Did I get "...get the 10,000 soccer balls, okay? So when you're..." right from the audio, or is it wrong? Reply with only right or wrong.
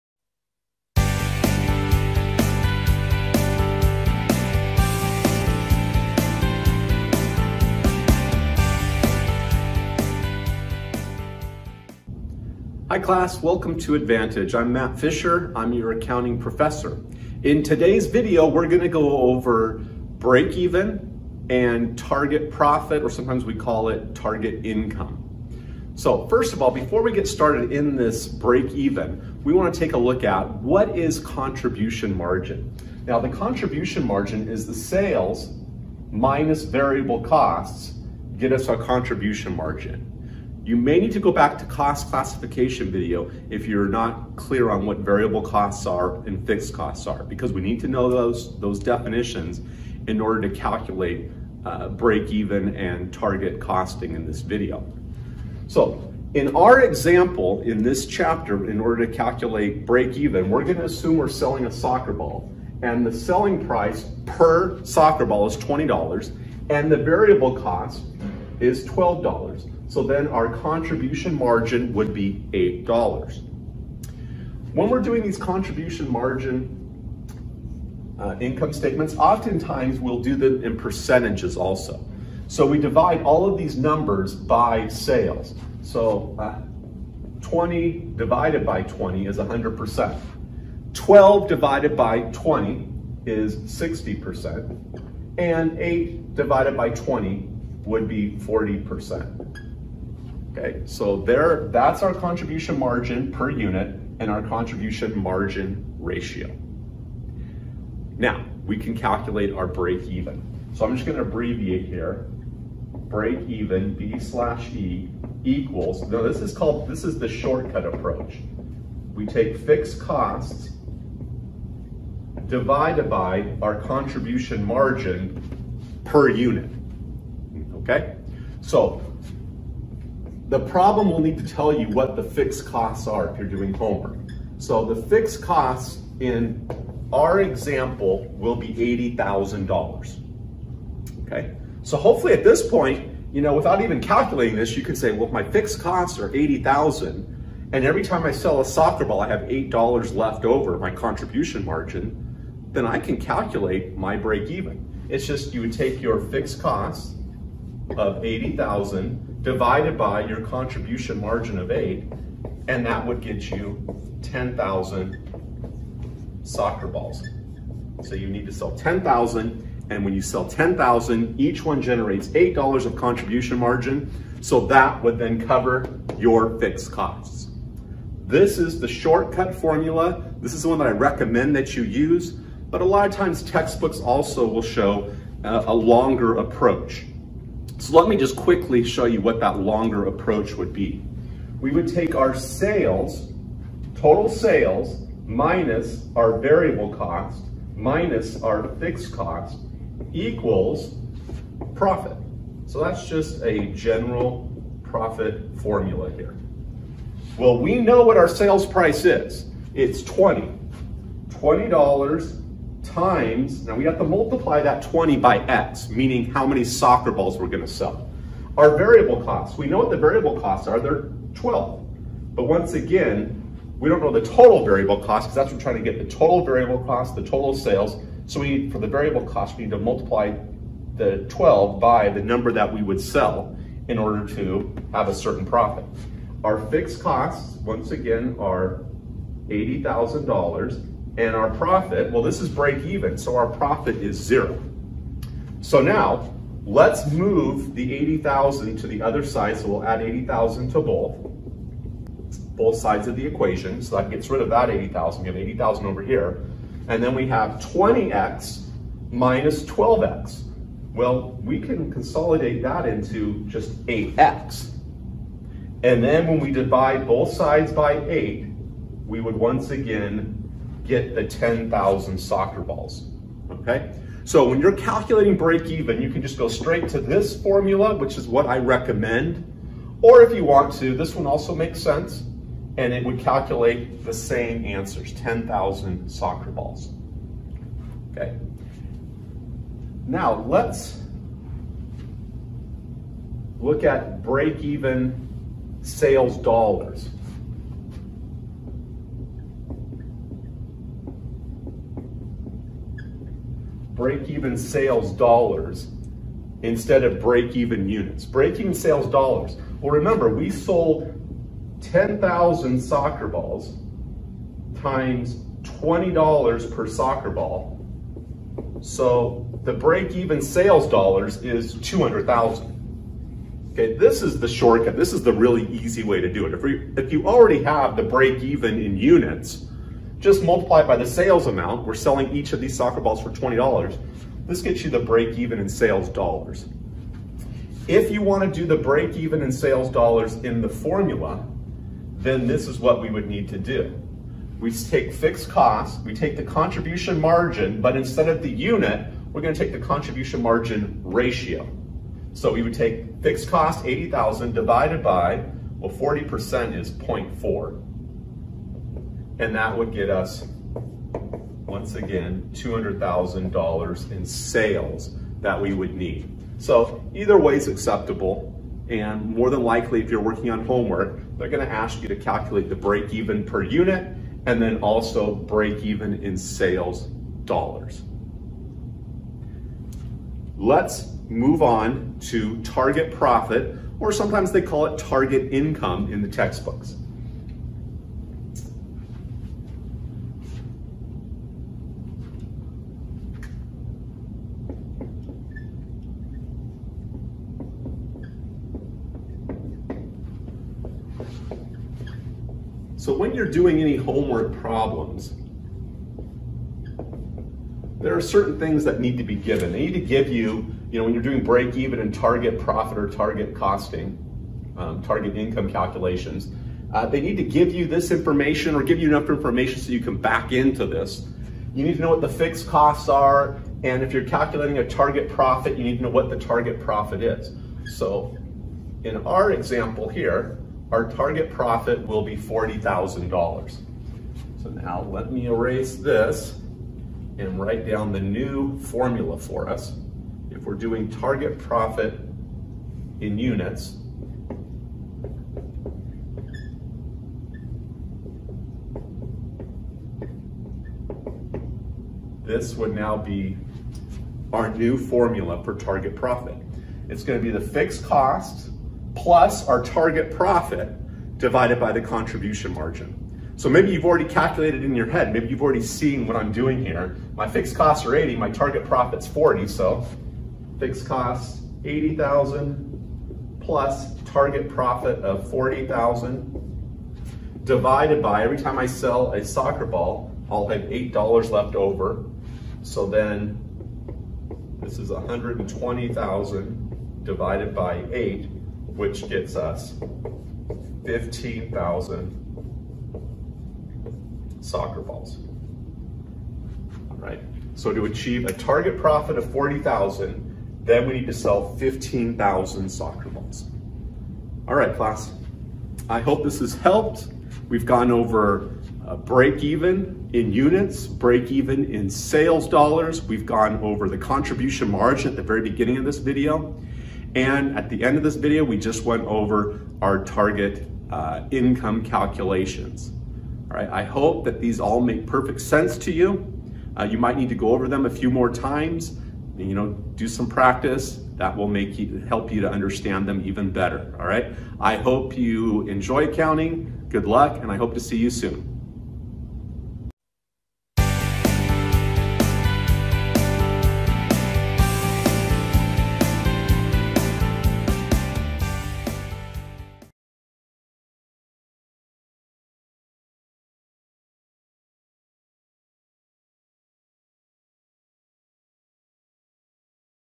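right.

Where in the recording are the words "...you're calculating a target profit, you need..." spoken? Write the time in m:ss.
7:04.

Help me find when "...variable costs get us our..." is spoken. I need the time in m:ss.
0:36.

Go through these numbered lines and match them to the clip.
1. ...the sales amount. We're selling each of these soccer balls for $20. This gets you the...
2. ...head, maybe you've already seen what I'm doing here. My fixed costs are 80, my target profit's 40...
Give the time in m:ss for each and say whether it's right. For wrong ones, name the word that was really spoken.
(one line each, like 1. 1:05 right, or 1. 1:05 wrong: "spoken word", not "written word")
1. 5:30 right
2. 7:45 right.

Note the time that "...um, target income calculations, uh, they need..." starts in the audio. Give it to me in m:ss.
6:54.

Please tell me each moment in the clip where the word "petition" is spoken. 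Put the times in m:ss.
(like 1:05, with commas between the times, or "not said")
not said.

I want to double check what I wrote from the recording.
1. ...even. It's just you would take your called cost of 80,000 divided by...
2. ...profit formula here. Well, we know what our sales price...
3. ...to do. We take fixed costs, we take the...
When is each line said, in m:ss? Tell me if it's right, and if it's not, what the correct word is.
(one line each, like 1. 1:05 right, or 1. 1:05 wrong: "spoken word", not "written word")
1. 2:34 wrong: "fixed", not "called"
2. 3:24 right
3. 5:43 right.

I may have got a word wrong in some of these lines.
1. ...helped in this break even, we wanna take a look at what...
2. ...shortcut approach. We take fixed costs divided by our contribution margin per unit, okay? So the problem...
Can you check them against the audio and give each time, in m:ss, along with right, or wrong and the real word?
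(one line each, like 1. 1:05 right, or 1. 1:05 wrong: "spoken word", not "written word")
1. 0:27 wrong: "started", not "helped"
2. 1:57 right.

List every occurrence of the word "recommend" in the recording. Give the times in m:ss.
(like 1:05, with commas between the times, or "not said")
3:00, 4:38.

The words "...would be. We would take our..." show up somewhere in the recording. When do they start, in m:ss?
3:10.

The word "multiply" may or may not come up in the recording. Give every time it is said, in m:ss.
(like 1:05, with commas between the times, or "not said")
3:34, 3:49, 5:30.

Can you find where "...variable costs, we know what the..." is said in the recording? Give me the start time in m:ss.
3:38.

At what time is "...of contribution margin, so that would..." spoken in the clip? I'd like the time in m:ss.
2:52.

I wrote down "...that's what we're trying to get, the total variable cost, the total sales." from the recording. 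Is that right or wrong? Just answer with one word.
right.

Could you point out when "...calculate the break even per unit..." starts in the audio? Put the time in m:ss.
6:12.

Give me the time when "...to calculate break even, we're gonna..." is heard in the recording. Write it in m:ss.
0:59.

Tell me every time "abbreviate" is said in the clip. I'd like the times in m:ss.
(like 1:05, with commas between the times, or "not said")
1:51.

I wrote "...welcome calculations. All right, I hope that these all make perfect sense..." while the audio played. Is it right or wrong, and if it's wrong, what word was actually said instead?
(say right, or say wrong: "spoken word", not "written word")
wrong: "income", not "welcome".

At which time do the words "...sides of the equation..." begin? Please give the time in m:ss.
4:12.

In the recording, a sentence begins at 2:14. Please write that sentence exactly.
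So the fixed costs in our example will be $80,000.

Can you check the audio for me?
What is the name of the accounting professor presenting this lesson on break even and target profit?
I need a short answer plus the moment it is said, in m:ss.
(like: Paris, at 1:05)
Matt Fisher, at 0:14.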